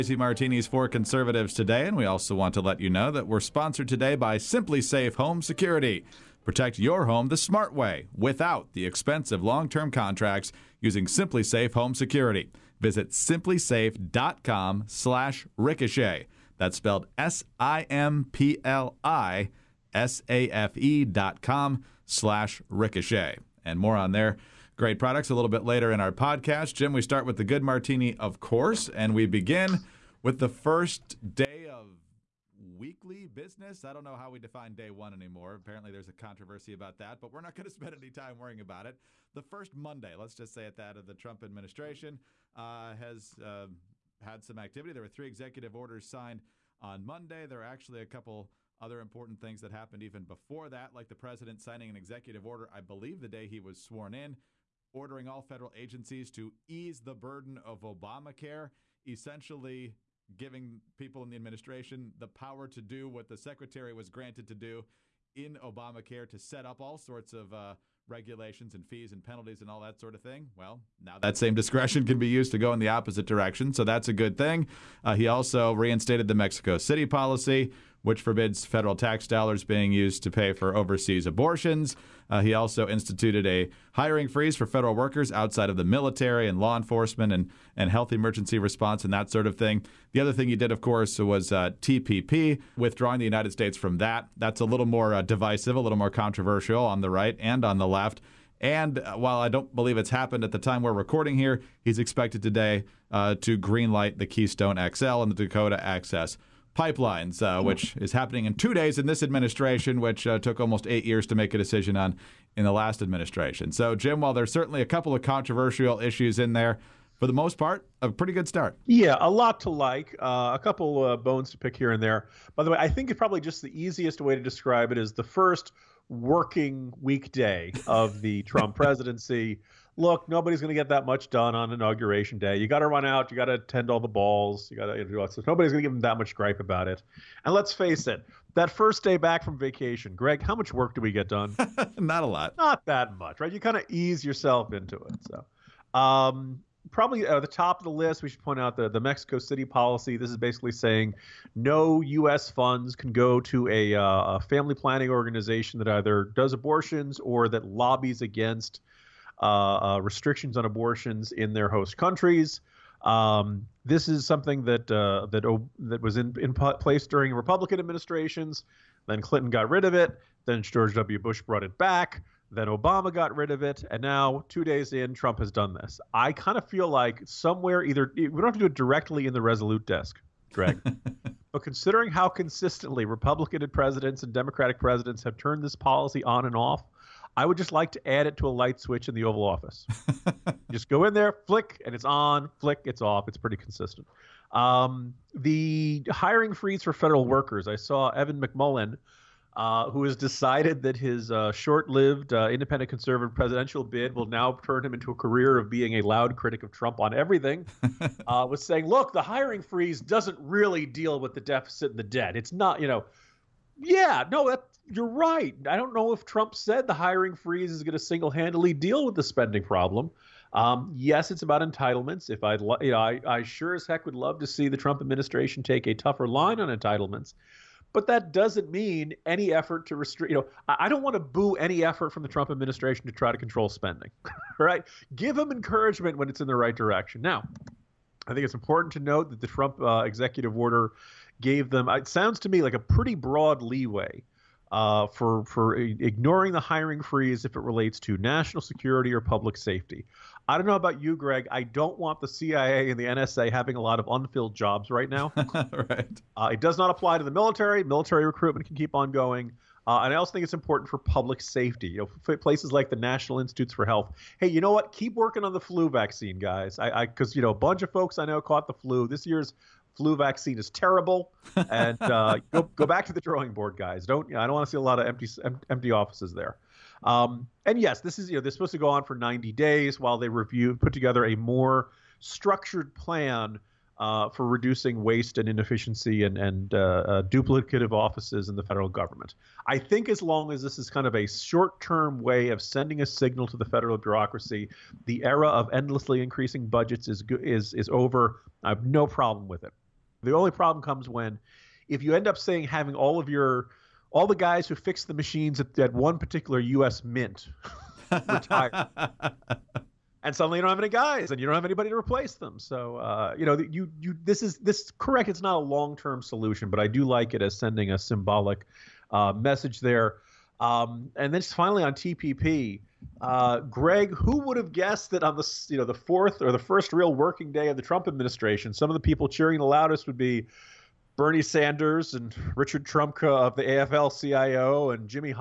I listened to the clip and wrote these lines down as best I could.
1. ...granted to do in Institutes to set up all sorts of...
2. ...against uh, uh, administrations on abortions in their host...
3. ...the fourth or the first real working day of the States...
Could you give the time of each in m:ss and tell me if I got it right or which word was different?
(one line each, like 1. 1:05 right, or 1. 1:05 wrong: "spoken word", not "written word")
1. 1:04 wrong: "Obamacare", not "Institutes"
2. 2:38 wrong: "restrictions", not "administrations"
3. 5:25 wrong: "Trump", not "States".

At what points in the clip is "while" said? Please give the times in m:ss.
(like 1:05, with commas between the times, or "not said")
1:39, 1:54, 4:39.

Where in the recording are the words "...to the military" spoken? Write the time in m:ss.
4:17.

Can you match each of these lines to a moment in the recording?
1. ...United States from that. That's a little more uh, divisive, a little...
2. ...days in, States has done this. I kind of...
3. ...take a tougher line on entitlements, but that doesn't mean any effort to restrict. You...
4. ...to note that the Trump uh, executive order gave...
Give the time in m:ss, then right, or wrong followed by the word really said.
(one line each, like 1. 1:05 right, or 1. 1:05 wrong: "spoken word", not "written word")
1. 1:33 right
2. 2:54 wrong: "Trump", not "States"
3. 3:45 right
4. 3:58 right.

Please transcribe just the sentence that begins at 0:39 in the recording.
The first Monday, let's just say at that, of the Trump administration uh, has uh, had some activity.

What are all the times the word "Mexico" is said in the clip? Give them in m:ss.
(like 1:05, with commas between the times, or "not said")
1:16, 2:28.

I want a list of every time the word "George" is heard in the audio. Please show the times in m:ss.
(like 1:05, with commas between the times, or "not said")
2:50.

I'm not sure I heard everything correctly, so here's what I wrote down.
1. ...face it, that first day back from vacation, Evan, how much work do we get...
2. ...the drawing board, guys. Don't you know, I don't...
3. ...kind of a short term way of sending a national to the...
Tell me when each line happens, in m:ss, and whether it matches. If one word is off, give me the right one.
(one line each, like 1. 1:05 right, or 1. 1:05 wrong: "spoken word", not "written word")
1. 2:17 wrong: "Greg", not "Evan"
2. 4:33 right
3. 4:50 wrong: "signal", not "national".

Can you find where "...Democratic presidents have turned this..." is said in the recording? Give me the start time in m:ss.
3:04.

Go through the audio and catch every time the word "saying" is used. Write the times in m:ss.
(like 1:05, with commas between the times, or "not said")
2:30, 3:28, 5:02.